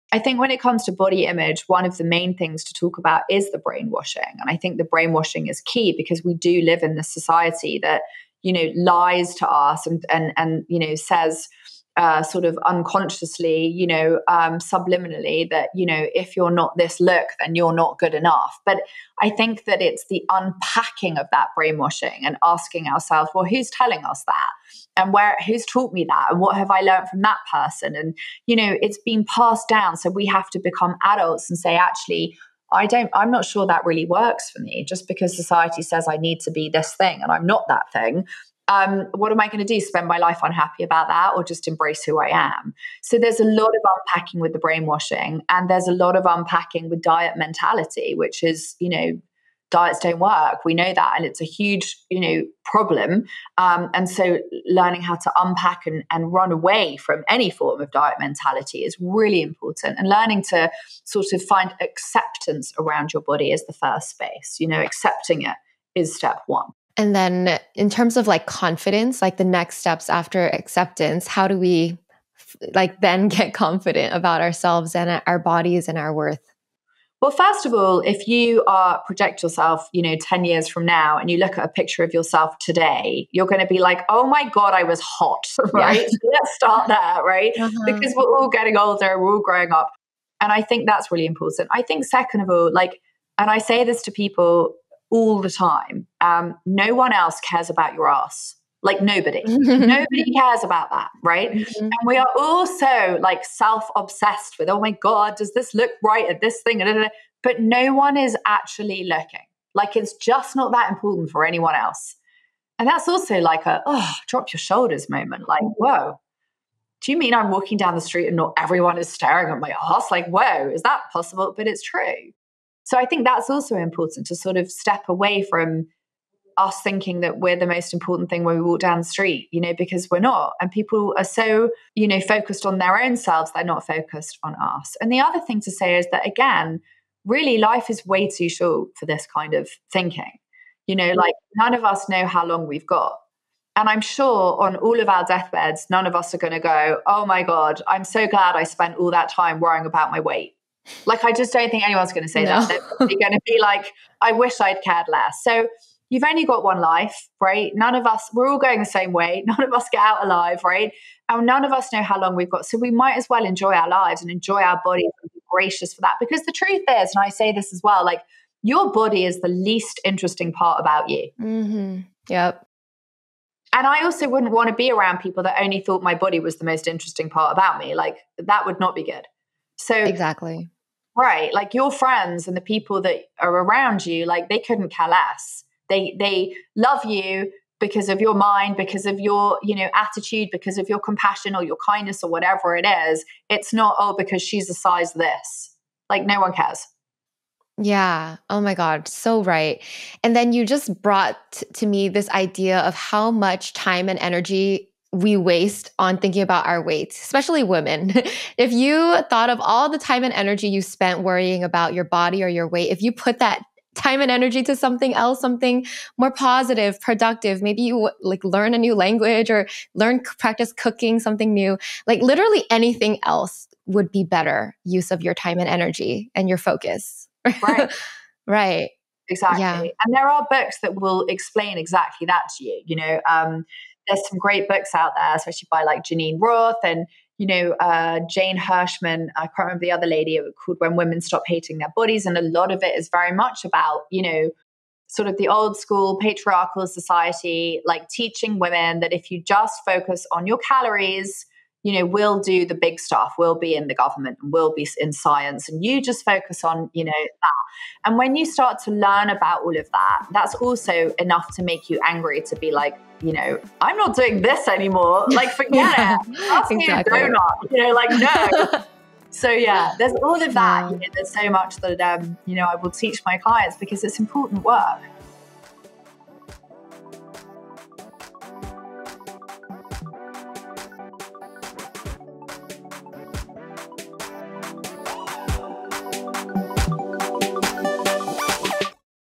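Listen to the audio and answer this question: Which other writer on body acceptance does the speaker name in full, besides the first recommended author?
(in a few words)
Jane Hirschmann.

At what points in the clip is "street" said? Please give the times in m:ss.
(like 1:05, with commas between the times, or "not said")
1:58, 2:09.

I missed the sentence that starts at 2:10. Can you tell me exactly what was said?
And people are so, you know, focused on their own selves, they're not focused on us.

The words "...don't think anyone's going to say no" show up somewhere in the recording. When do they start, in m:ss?
2:31.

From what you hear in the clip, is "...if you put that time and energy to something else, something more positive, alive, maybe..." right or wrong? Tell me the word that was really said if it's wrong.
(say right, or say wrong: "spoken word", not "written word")
wrong: "productive", not "alive".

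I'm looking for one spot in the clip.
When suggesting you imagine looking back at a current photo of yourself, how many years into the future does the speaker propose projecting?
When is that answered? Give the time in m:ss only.
1:20.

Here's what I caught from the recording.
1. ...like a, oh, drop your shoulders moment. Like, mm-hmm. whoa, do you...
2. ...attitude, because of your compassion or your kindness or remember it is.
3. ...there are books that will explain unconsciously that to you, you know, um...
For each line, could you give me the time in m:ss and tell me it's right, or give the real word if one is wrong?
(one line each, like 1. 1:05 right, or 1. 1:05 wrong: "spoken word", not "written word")
1. 1:53 right
2. 3:09 wrong: "whatever", not "remember"
3. 3:50 wrong: "exactly", not "unconsciously".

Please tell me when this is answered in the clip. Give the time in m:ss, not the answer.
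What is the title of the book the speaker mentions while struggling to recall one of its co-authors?
4:00.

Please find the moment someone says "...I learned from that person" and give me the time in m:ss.
0:26.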